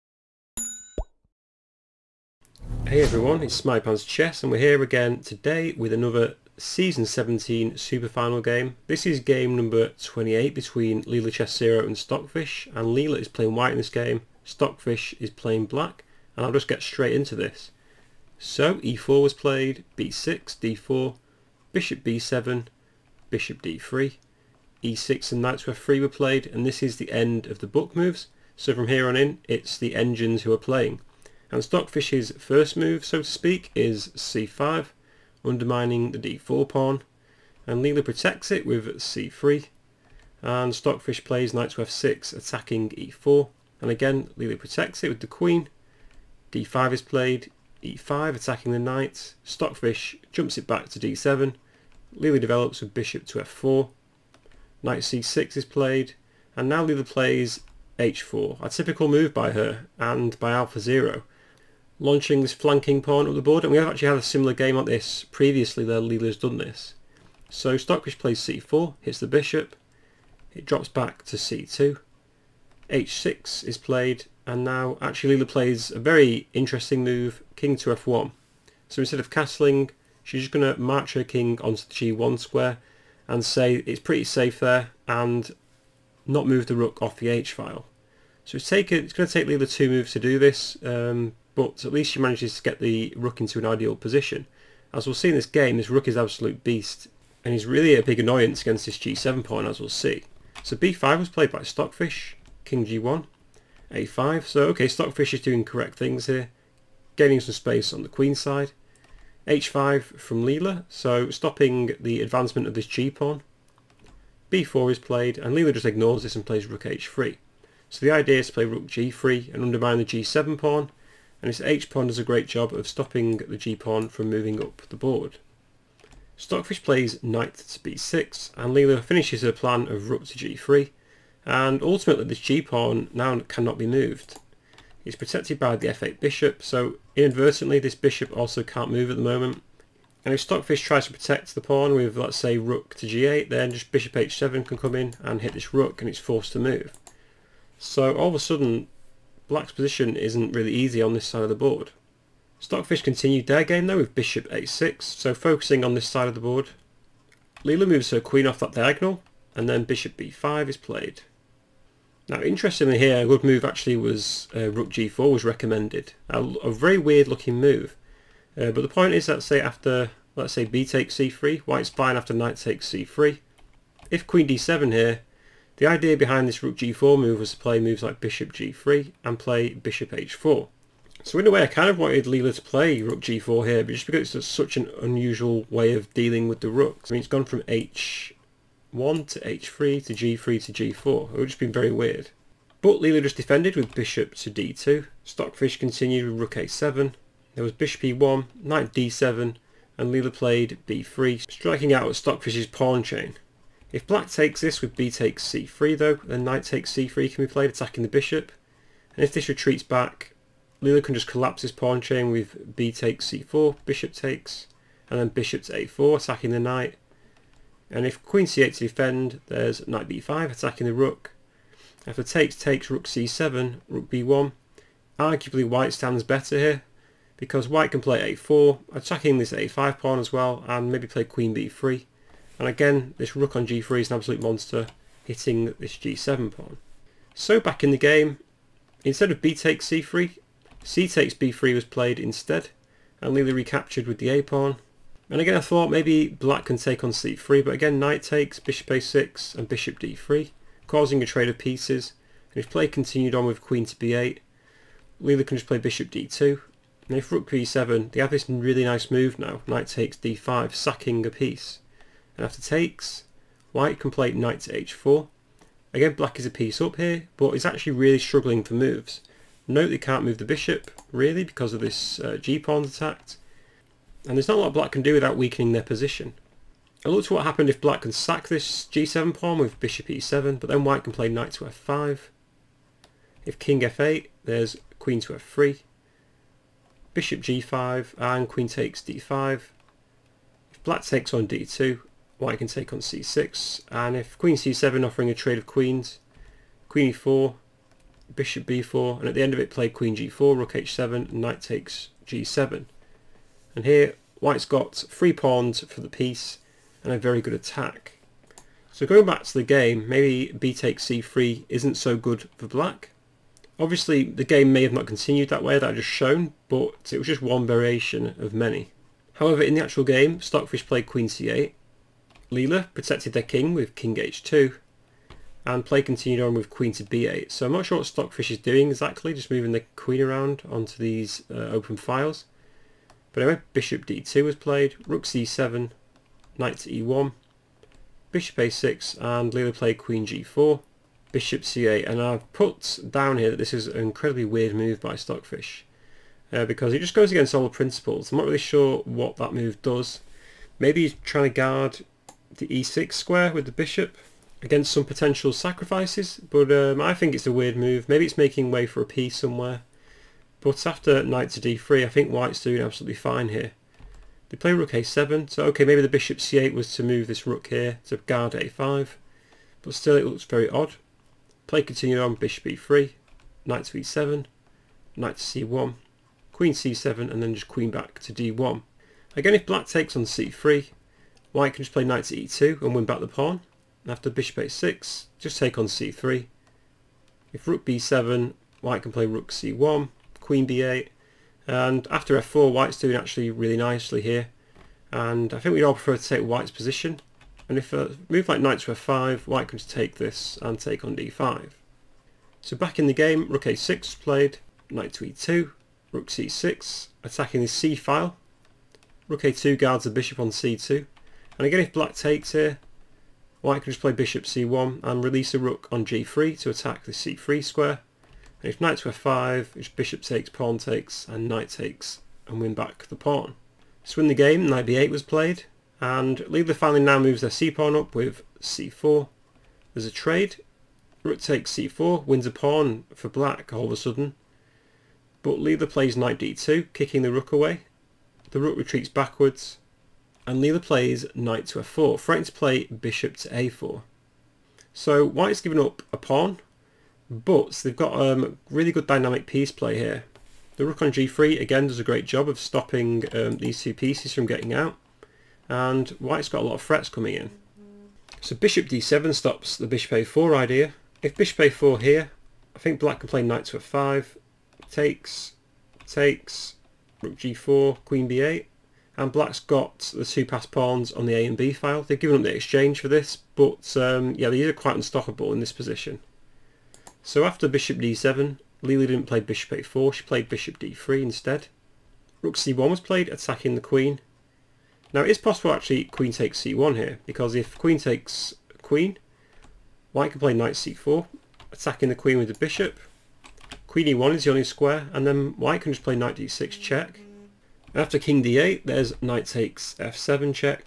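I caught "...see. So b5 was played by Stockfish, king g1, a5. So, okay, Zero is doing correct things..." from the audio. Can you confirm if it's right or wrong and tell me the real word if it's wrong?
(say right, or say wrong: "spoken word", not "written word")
wrong: "Stockfish", not "Zero".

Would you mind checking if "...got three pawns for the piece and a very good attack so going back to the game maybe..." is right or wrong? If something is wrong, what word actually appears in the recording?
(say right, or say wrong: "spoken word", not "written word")
right.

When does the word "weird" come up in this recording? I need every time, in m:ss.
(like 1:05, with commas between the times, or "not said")
2:46, 3:11, 5:44, 5:57.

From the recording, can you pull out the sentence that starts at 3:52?
And again, this rook on g3 is an absolute monster, hitting this g7 pawn.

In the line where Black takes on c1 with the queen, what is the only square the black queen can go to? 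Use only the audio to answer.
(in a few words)
e1.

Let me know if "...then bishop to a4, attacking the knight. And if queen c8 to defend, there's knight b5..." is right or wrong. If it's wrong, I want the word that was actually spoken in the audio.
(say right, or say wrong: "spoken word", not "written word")
right.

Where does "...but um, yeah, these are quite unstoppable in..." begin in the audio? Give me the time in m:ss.
7:53.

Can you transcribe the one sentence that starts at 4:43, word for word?
If king f8, there's queen to f3, bishop g5, and queen takes d5.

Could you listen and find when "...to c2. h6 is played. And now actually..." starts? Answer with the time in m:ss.
1:11.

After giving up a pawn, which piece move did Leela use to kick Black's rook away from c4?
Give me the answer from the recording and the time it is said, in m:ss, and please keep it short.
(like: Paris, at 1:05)
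Knight d2, at 7:16.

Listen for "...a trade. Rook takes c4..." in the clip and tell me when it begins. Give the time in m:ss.
7:10.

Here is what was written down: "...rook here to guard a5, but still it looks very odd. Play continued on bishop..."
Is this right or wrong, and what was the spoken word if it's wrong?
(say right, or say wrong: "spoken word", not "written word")
right.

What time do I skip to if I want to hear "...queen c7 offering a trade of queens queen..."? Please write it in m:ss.
4:54.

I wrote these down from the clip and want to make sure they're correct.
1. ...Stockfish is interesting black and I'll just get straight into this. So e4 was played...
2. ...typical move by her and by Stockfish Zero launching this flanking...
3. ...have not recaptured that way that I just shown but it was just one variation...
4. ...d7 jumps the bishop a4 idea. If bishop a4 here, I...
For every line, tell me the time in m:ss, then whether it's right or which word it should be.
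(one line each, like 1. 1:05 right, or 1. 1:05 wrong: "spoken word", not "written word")
1. 0:14 wrong: "playing", not "interesting"
2. 0:58 wrong: "Alpha", not "Stockfish"
3. 5:14 wrong: "continued", not "recaptured"
4. 7:38 wrong: "stops", not "jumps".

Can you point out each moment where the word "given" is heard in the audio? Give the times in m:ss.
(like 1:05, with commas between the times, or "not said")
7:25, 7:52.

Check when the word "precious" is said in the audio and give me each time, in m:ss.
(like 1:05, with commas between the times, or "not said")
not said.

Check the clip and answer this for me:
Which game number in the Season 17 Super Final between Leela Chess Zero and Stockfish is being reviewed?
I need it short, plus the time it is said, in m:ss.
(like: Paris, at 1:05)
28, at 0:09.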